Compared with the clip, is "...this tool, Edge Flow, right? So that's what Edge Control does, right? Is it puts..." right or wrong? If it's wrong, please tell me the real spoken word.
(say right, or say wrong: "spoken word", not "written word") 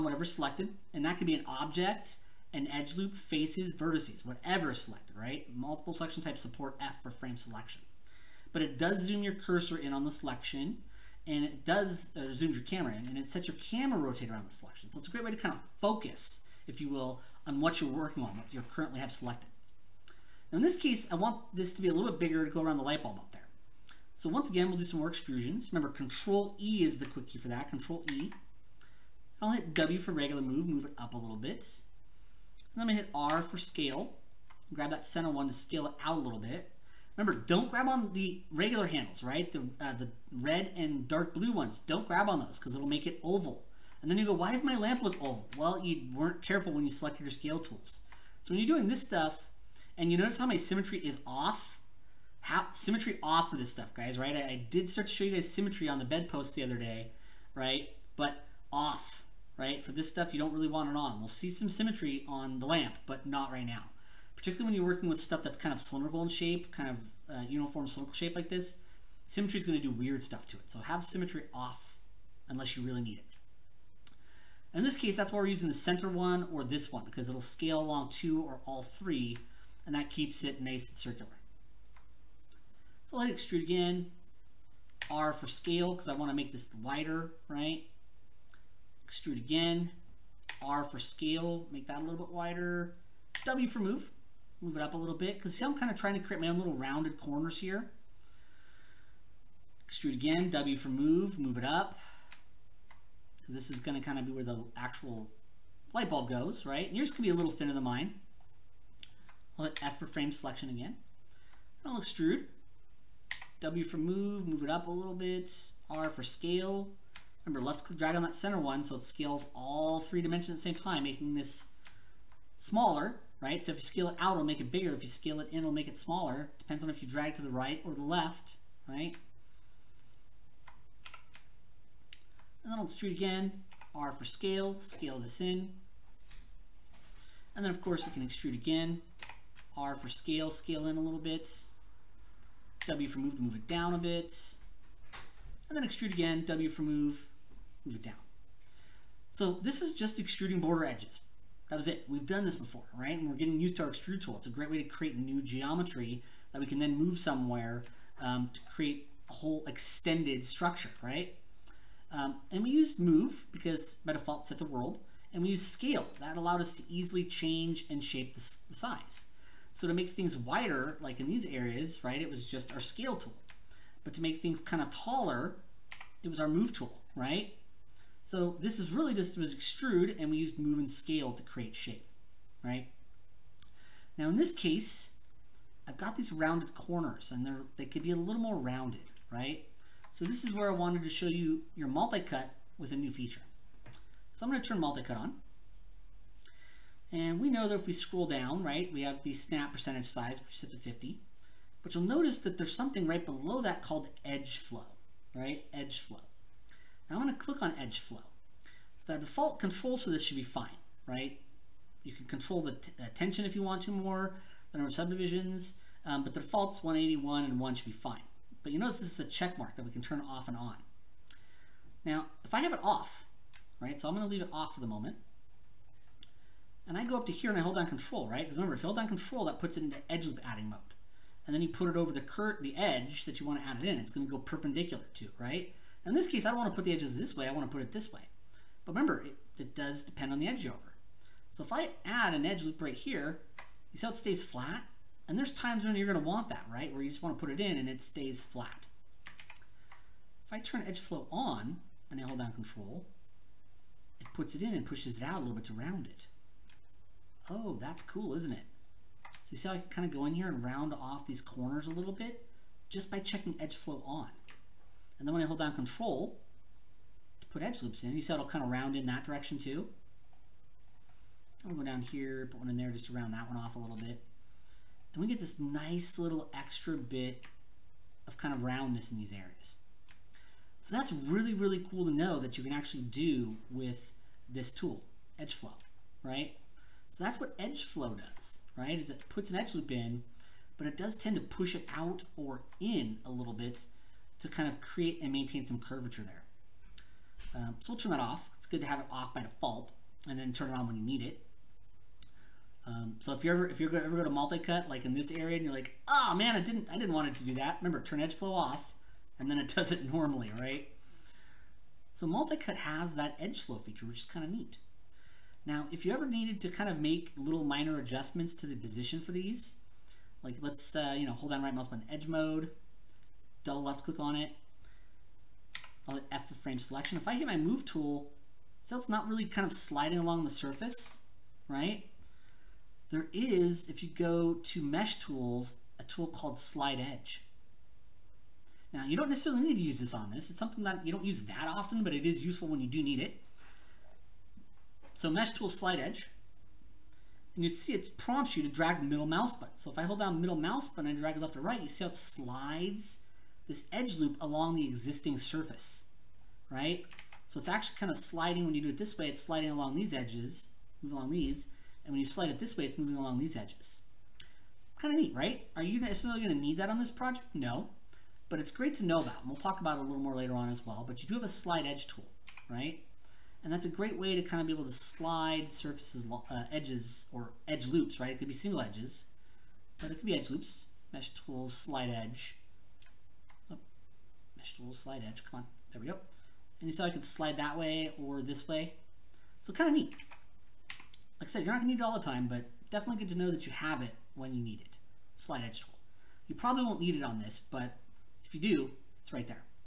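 wrong: "Flow", not "Control".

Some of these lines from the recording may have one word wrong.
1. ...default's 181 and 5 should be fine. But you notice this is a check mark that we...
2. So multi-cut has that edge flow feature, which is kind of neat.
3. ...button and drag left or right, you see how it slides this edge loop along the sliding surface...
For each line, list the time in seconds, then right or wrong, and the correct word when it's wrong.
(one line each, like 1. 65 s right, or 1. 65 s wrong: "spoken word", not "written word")
1. 216 s wrong: "1", not "5"
2. 312 s right
3. 350 s wrong: "existing", not "sliding".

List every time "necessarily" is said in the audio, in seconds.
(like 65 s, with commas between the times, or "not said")
339 s, 365 s.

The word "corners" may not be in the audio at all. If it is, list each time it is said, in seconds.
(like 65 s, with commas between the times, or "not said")
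97 s, 186 s, 261 s.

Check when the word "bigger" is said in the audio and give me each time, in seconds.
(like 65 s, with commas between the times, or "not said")
22 s, 124 s.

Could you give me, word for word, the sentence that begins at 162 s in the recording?
Um, and we used move because by default set to world.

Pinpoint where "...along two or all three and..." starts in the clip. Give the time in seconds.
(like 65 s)
77 s.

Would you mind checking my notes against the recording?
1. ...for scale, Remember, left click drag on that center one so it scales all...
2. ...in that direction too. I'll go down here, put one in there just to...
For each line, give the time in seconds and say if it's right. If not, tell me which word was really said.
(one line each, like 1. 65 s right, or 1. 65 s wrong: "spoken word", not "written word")
1. 116 s right
2. 268 s right.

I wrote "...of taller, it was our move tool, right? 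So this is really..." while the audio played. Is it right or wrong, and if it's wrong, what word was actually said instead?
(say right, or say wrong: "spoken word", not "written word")
right.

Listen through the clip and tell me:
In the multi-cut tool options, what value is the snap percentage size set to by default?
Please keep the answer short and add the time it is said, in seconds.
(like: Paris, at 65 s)
50, at 200 s.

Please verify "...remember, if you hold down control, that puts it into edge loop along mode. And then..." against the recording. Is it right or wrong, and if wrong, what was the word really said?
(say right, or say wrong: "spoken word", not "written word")
wrong: "adding", not "along".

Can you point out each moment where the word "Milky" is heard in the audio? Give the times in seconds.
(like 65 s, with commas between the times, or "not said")
not said.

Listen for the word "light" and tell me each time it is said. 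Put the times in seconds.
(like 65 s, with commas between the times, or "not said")
22 s, 105 s.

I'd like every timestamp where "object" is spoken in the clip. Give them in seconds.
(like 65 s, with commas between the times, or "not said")
1 s.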